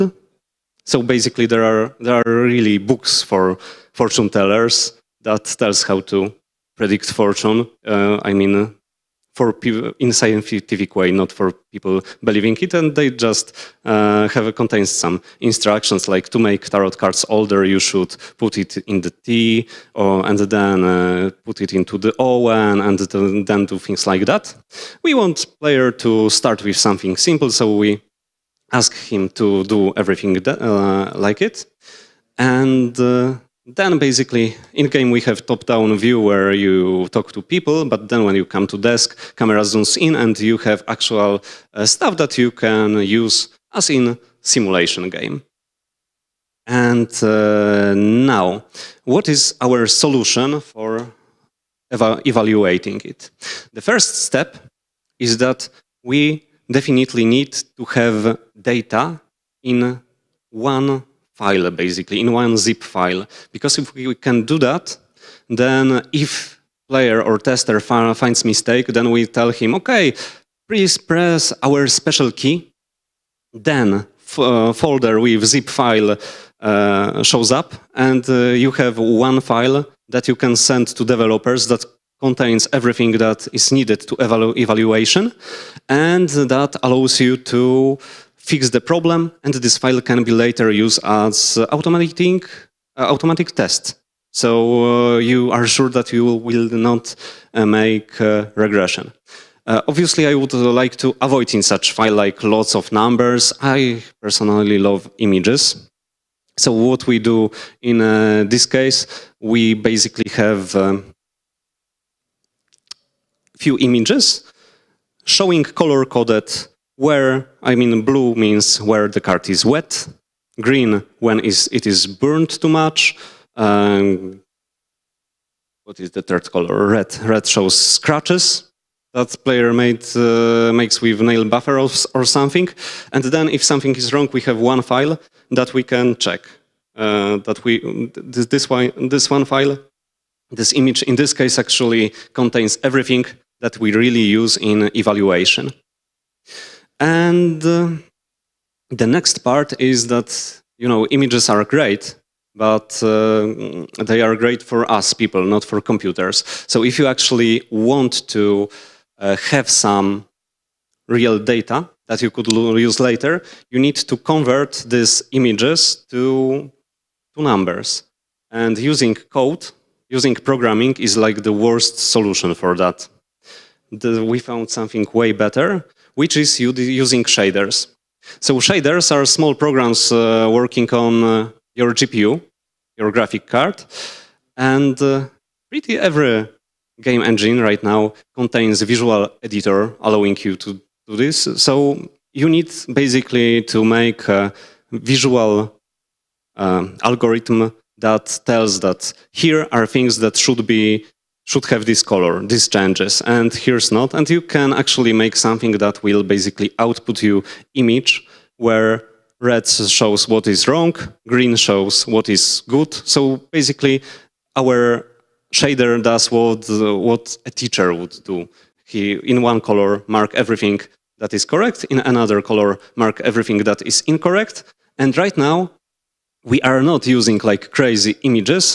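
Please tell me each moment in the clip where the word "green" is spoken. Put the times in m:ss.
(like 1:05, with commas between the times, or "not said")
2:00, 3:31.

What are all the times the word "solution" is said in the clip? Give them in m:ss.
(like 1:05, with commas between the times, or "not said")
0:49, 2:51.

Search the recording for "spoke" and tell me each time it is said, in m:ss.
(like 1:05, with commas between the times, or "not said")
not said.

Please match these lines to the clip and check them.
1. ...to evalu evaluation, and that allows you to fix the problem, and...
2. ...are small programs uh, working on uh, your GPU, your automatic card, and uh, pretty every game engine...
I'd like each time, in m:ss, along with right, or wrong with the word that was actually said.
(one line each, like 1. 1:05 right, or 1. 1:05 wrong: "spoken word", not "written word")
1. 1:24 right
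2. 2:59 wrong: "graphic", not "automatic".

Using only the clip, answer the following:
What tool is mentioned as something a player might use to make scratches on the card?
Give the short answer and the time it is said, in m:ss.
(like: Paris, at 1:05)
Nail buffer, at 2:11.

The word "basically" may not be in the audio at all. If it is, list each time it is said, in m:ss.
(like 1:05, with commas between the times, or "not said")
0:01, 0:33, 1:01, 1:49, 3:12, 3:26, 3:33.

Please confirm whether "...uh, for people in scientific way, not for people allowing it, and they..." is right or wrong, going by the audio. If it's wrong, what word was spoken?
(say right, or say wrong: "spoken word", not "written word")
wrong: "believing", not "allowing".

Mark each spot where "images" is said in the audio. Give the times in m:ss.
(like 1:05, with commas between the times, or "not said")
1:45, 1:53, 2:20, 2:31, 2:45, 3:27, 3:48.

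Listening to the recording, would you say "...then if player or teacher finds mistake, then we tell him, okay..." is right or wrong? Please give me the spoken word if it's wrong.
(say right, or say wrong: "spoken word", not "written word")
wrong: "tester", not "teacher".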